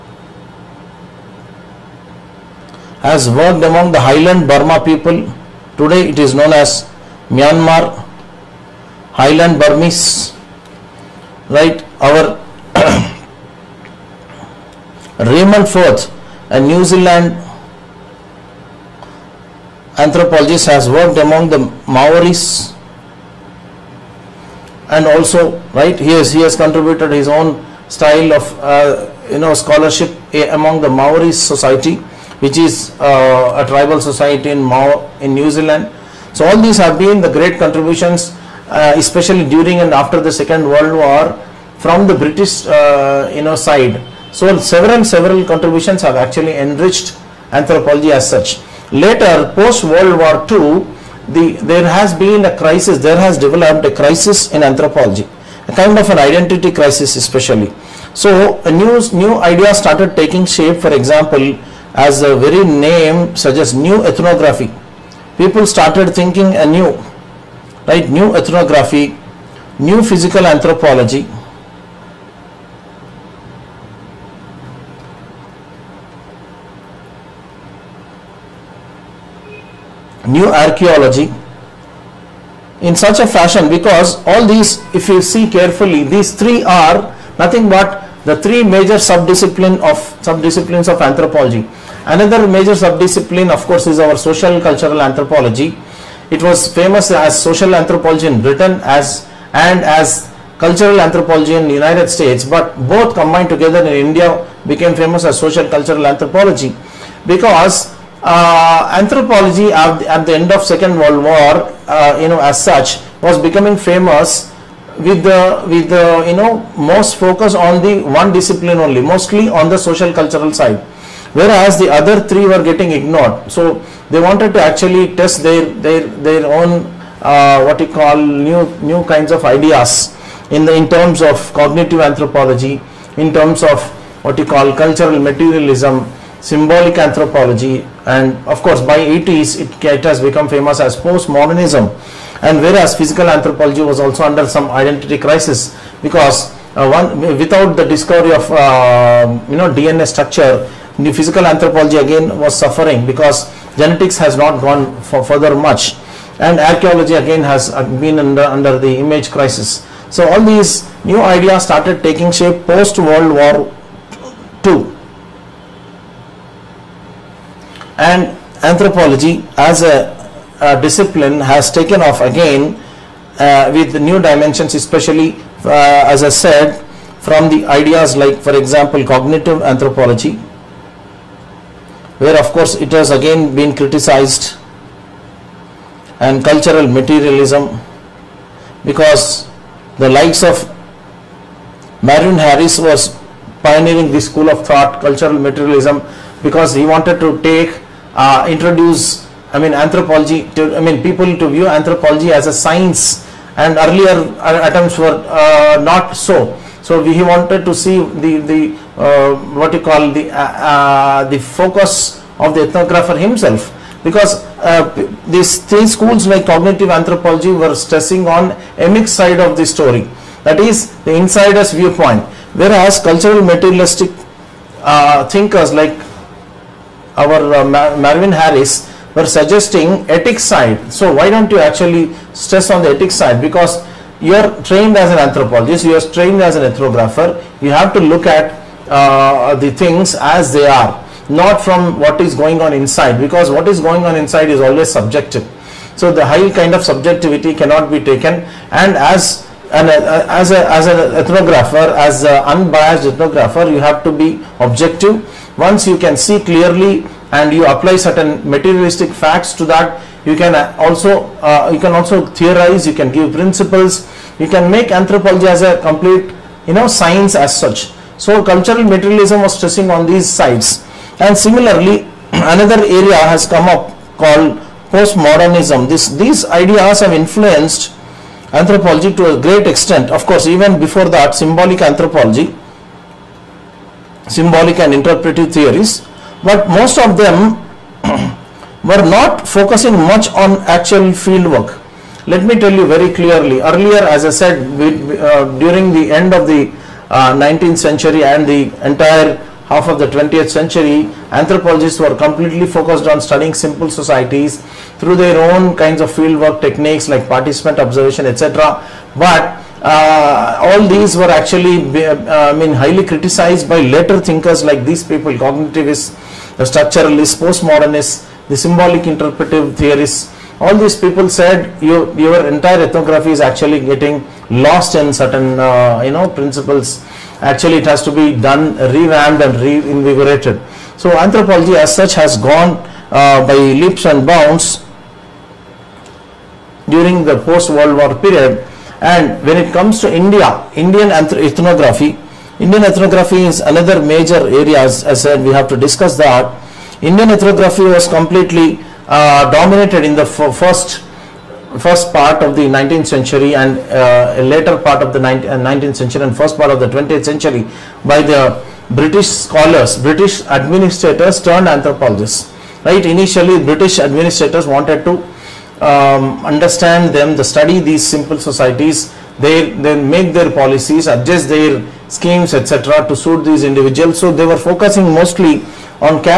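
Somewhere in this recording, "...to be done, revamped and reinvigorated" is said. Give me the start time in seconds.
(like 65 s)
328 s.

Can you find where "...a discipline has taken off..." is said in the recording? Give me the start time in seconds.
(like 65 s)
170 s.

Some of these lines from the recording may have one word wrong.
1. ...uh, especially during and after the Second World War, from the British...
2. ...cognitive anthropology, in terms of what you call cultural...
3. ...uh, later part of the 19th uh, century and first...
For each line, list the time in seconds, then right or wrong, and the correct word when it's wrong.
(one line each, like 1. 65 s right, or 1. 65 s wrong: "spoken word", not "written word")
1. 38 s right
2. 131 s right
3. 353 s right.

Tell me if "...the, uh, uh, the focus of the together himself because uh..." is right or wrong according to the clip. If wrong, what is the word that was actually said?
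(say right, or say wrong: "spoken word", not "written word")
wrong: "ethnographer", not "together".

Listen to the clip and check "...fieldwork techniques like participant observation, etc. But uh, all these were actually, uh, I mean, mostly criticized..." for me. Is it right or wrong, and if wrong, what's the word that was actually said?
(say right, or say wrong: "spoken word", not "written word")
wrong: "highly", not "mostly".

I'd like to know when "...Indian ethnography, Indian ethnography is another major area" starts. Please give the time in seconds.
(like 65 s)
340 s.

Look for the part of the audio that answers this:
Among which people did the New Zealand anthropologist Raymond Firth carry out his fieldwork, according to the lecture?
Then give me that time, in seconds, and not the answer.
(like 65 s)
21 s.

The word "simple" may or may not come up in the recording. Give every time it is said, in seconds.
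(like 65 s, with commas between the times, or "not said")
303 s, 368 s.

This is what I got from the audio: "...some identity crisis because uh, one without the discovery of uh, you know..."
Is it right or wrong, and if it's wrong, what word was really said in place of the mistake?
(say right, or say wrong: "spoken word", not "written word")
right.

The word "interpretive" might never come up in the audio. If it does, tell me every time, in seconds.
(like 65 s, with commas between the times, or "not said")
284 s, 319 s.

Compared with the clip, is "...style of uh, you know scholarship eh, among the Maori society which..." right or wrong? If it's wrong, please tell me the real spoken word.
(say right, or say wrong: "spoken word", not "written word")
right.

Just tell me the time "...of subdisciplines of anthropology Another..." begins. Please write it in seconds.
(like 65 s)
89 s.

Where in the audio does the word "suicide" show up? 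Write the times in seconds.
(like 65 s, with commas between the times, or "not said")
not said.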